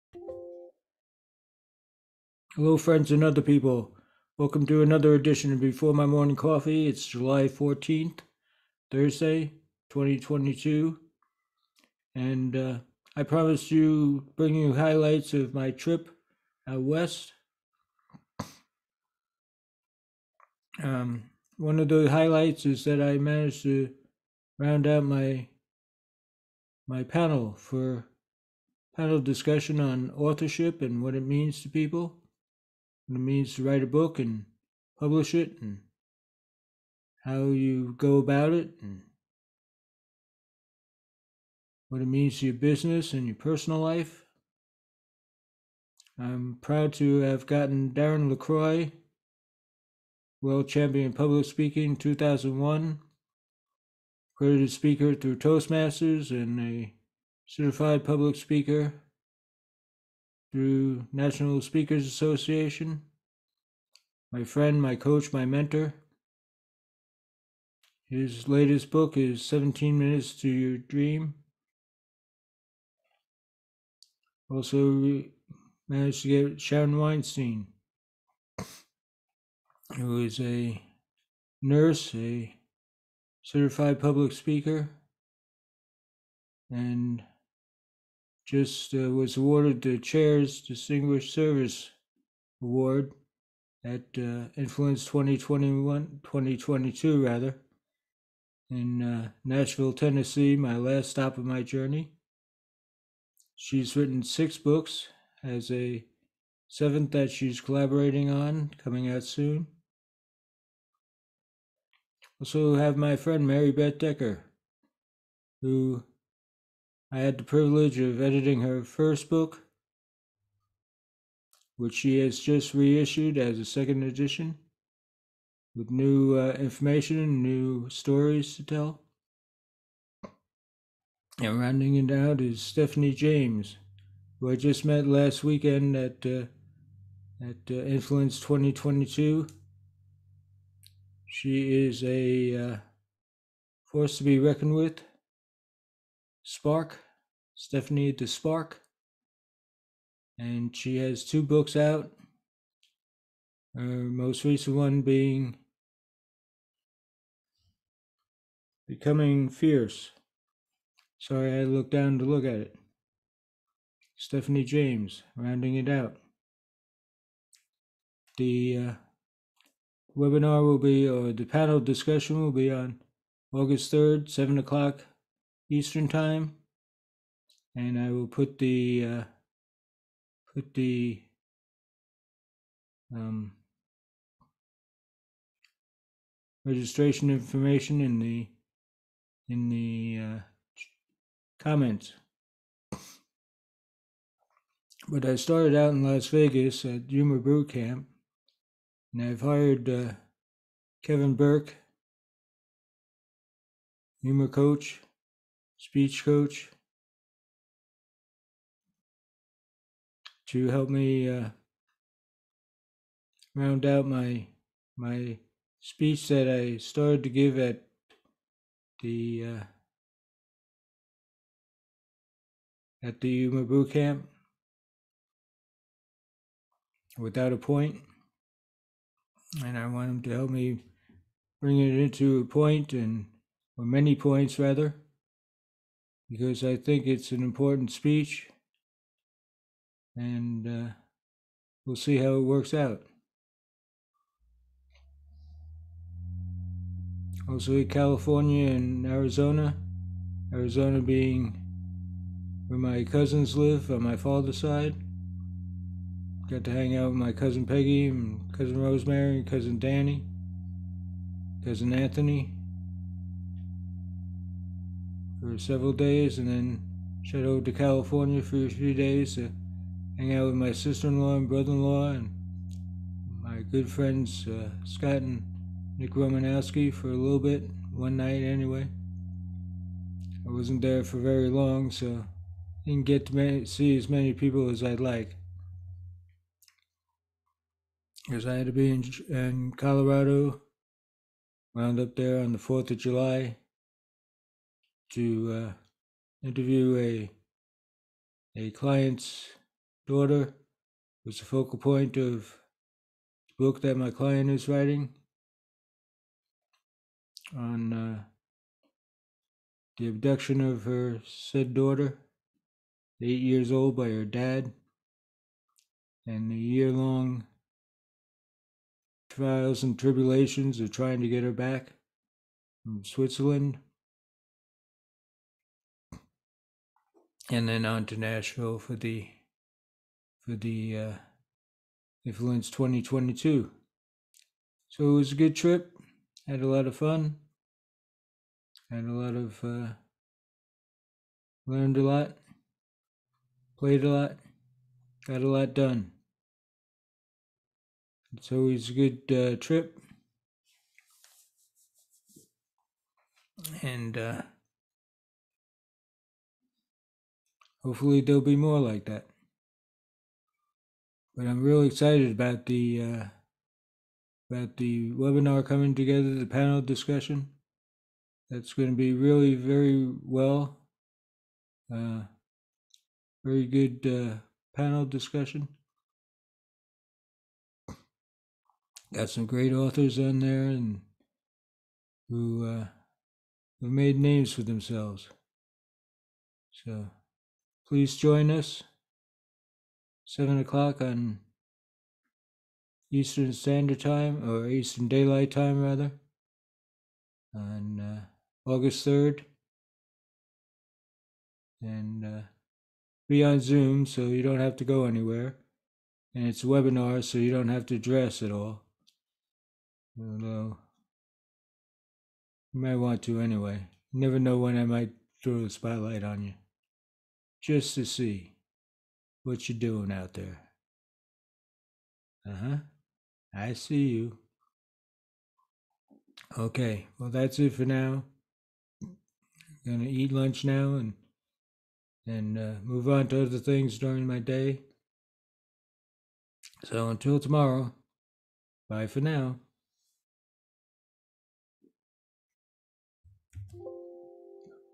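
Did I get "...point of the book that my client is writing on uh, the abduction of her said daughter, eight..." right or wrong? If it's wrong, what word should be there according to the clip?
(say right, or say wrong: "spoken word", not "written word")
right.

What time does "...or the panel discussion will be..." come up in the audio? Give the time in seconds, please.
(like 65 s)
171 s.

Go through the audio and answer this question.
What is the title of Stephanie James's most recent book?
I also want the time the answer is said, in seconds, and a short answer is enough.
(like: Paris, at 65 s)
Becoming Fierce, at 158 s.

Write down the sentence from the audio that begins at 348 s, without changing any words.
It's always a good uh, trip.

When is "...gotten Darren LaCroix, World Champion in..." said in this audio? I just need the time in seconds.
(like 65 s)
47 s.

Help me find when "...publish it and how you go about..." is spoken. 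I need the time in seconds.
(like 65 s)
34 s.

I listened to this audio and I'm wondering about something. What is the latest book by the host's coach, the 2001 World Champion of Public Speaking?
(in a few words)
17 Minutes to Your Dream.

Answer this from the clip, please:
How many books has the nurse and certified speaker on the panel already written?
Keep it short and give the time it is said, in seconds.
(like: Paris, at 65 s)
6, at 104 s.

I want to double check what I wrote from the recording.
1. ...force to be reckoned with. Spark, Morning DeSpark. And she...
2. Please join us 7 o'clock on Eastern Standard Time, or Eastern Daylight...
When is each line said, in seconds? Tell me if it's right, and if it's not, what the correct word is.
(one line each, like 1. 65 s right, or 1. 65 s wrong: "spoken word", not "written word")
1. 143 s wrong: "Stephanie", not "Morning"
2. 387 s right.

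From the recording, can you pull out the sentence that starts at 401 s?
And uh, be on Zoom so you don't have to go anywhere.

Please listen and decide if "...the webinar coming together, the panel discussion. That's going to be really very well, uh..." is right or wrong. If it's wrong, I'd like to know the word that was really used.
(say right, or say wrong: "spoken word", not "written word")
right.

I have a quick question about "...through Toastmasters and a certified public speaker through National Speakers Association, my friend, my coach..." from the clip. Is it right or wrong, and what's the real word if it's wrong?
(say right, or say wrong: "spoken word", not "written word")
right.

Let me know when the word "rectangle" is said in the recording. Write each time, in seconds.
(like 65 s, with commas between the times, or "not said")
not said.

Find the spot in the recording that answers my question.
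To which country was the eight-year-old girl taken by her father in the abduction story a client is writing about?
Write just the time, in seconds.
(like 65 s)
323 s.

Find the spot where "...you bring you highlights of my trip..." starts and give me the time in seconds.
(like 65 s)
13 s.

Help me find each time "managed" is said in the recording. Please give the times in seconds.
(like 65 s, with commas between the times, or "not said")
23 s, 75 s.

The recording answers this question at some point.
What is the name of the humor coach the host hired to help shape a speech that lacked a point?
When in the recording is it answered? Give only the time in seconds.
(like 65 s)
201 s.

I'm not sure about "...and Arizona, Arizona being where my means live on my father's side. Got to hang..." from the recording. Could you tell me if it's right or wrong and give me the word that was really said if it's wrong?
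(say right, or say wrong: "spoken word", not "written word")
wrong: "cousins", not "means".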